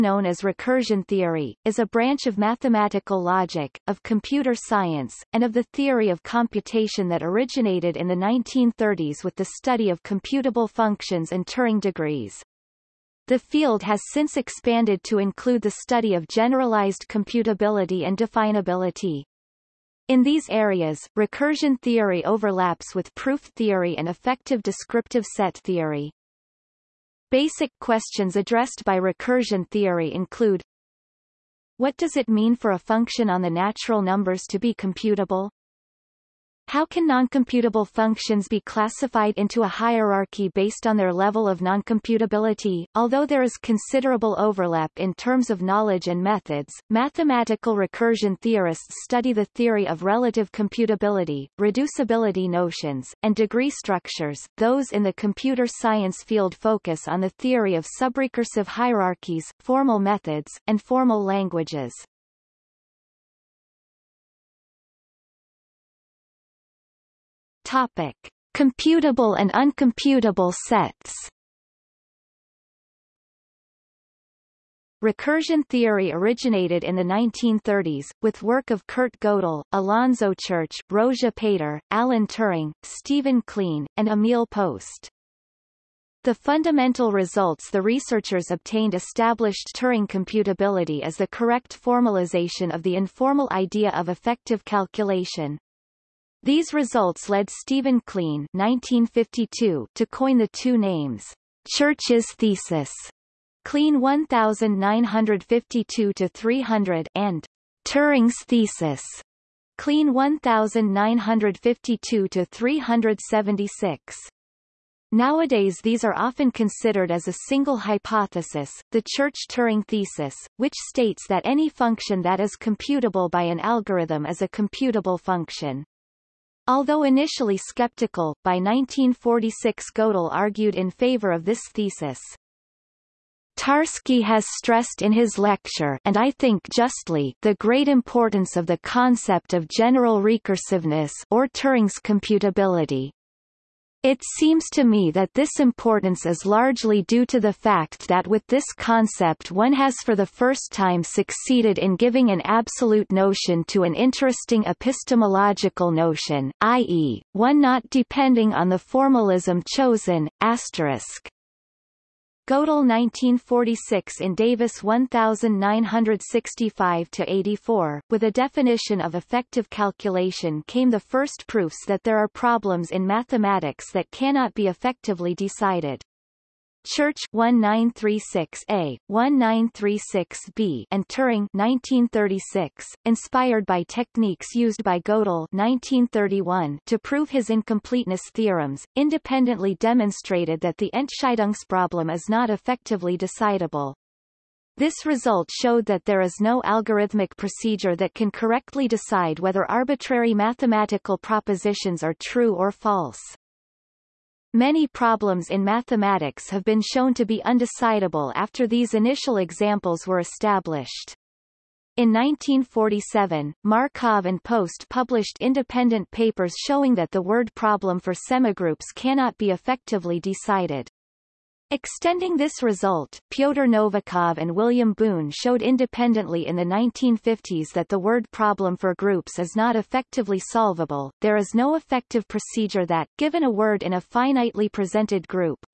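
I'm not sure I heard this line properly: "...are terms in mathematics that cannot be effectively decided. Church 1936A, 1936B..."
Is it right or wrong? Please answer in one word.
wrong.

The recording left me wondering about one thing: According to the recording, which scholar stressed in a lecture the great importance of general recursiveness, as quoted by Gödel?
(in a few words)
Tarski.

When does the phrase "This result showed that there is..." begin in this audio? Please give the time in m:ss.
3:14.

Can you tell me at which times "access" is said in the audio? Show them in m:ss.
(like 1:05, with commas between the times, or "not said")
not said.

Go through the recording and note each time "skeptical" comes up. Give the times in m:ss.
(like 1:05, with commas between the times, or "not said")
2:07.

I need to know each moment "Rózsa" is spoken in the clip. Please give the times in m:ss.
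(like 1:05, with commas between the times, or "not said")
1:20.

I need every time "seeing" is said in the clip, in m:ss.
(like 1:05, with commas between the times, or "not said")
not said.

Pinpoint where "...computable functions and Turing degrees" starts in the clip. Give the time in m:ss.
0:10.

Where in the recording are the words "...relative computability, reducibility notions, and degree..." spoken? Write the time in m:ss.
0:50.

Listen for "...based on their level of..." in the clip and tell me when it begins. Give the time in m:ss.
0:40.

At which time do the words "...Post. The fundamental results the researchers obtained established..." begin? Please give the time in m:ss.
1:24.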